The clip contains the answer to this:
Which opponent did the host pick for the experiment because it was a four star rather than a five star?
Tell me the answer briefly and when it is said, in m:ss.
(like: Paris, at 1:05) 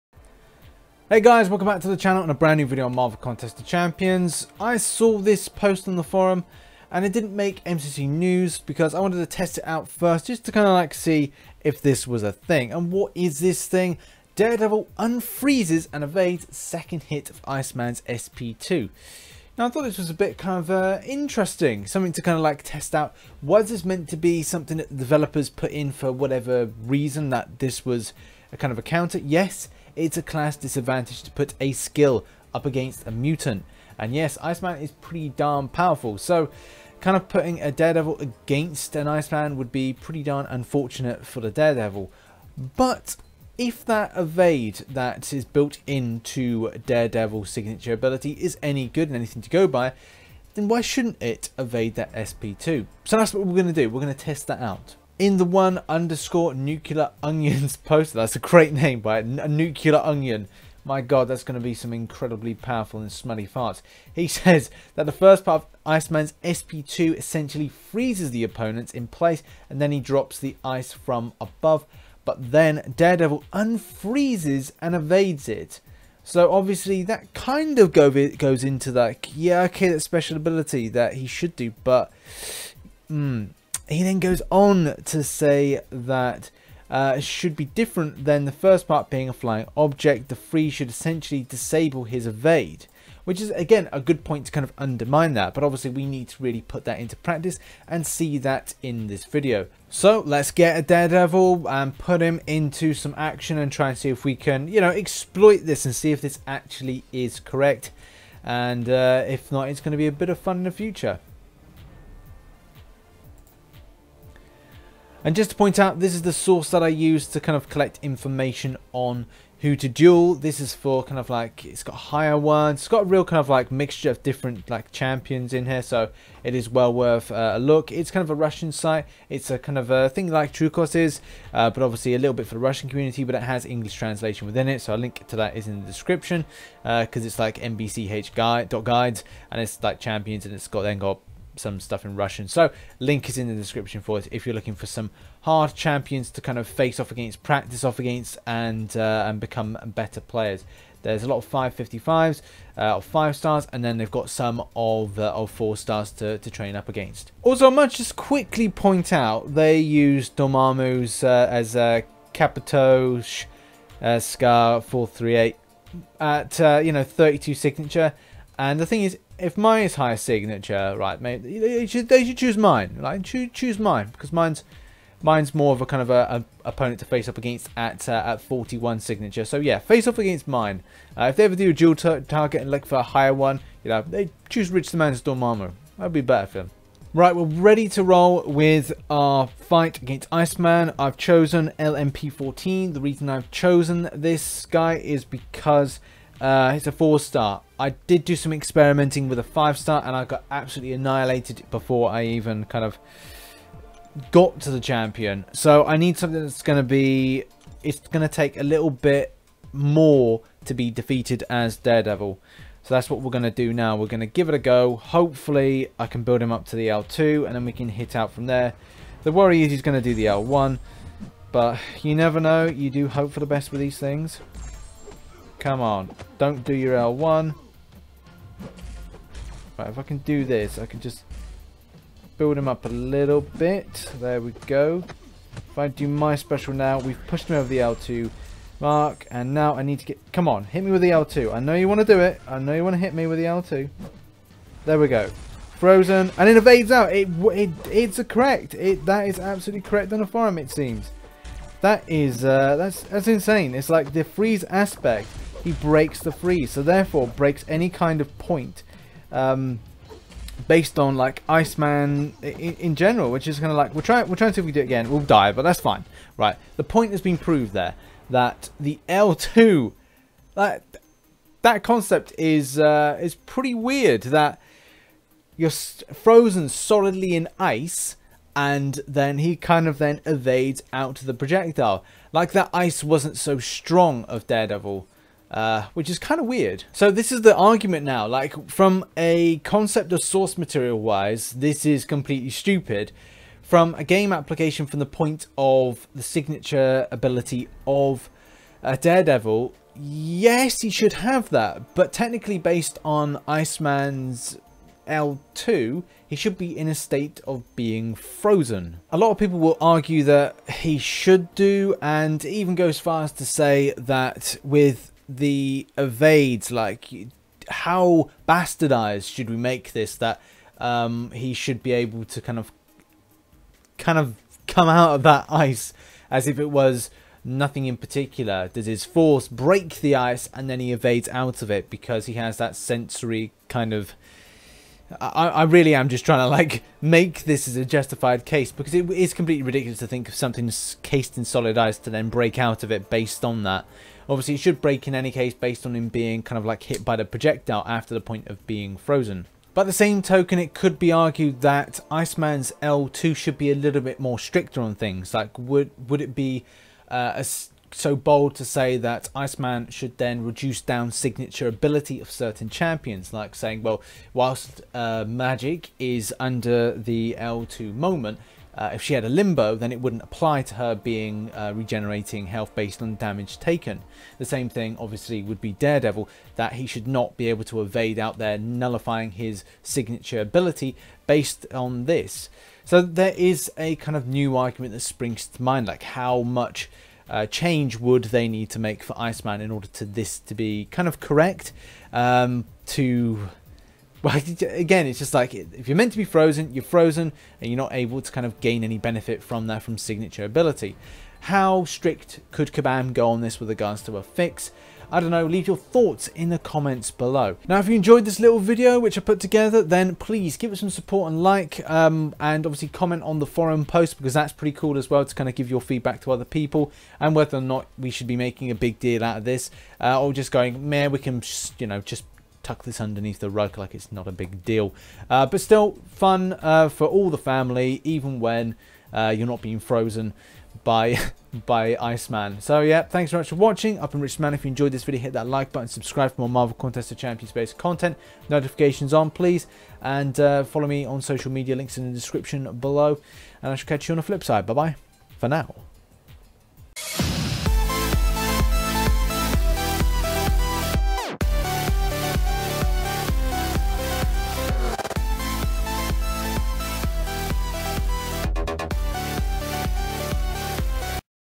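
LMP14, at 3:11.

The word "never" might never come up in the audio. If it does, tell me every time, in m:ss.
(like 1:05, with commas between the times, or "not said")
3:42.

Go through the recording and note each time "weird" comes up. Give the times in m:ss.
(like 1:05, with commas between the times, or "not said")
4:33, 4:46.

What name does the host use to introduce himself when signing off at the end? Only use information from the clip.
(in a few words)
Rich Man.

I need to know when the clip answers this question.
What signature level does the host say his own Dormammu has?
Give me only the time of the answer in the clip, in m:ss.
2:58.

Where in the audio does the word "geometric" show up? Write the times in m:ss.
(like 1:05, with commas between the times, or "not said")
not said.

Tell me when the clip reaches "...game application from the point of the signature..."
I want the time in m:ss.
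4:54.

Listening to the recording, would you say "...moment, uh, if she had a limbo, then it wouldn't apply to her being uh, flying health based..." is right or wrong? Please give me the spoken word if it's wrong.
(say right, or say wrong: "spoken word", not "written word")
wrong: "regenerating", not "flying".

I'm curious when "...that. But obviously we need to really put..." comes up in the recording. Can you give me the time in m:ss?
1:35.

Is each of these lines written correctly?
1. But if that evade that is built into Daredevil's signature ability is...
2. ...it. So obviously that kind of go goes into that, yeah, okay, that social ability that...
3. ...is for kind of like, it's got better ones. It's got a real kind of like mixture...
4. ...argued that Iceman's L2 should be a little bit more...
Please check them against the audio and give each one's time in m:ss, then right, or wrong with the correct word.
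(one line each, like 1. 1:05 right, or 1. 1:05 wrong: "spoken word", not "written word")
1. 0:42 right
2. 1:15 wrong: "special", not "social"
3. 2:00 wrong: "higher", not "better"
4. 5:51 right.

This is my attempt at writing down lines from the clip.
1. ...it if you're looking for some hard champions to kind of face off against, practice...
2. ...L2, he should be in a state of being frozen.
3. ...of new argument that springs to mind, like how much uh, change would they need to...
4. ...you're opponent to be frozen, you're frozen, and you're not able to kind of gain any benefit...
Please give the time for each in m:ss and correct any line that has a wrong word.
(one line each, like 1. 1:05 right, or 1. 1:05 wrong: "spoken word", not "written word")
1. 2:24 right
2. 5:05 right
3. 6:24 right
4. 6:35 wrong: "meant", not "opponent".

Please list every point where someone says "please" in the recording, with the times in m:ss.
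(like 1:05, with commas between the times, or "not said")
6:50, 7:19.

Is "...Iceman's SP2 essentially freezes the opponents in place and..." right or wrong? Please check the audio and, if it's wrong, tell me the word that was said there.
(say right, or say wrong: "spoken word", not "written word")
right.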